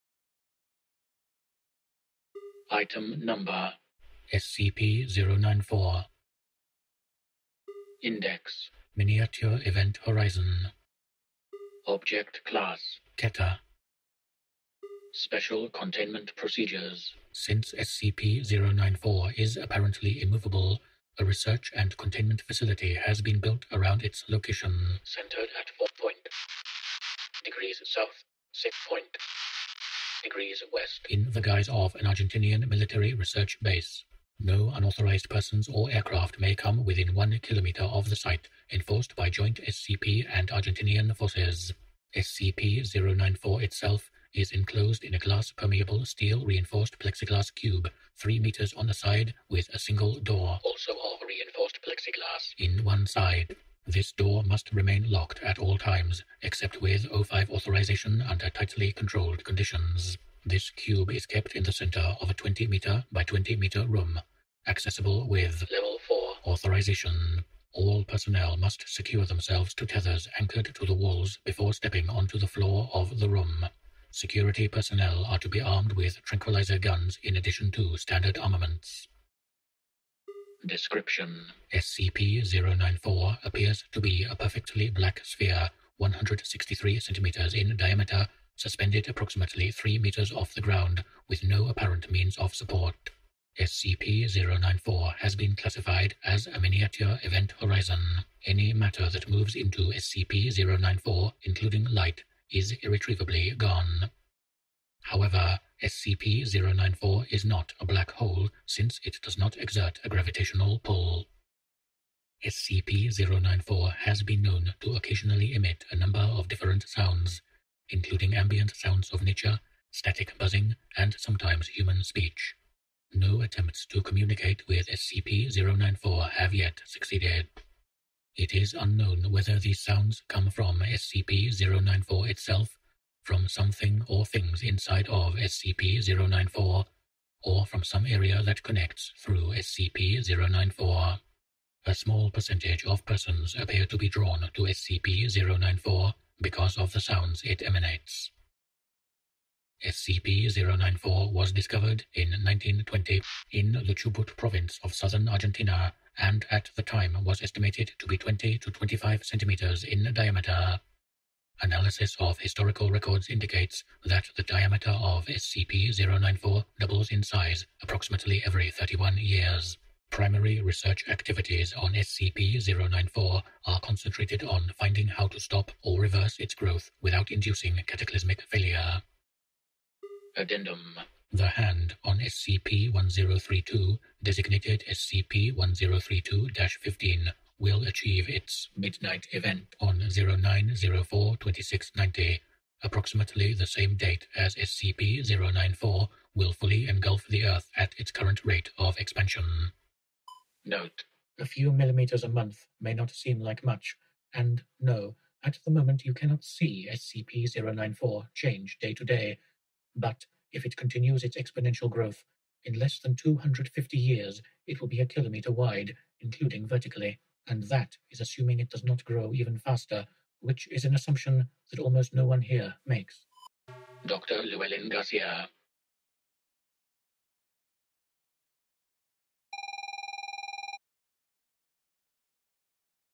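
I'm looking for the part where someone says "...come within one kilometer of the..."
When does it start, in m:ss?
0:36.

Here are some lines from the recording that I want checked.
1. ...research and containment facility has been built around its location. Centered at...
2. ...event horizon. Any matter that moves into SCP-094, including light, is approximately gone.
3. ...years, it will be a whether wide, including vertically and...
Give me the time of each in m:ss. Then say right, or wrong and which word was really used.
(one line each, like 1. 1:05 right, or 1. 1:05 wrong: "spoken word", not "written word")
1. 0:21 right
2. 1:37 wrong: "irretrievably", not "approximately"
3. 3:33 wrong: "kilometer", not "whether".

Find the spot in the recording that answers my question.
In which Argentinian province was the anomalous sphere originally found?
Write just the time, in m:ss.
2:33.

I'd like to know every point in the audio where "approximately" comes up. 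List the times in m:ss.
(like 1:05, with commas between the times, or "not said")
1:29, 2:47, 3:12.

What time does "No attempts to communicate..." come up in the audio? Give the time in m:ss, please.
2:03.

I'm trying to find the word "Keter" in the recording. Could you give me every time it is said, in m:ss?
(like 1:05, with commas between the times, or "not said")
0:13.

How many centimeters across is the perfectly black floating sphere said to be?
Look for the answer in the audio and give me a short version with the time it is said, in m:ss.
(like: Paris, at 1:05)
163 centimeters, at 1:25.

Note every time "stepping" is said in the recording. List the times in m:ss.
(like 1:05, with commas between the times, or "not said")
1:11.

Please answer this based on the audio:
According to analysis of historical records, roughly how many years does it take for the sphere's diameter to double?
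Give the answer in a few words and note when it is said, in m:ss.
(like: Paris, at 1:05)
31 years, at 2:48.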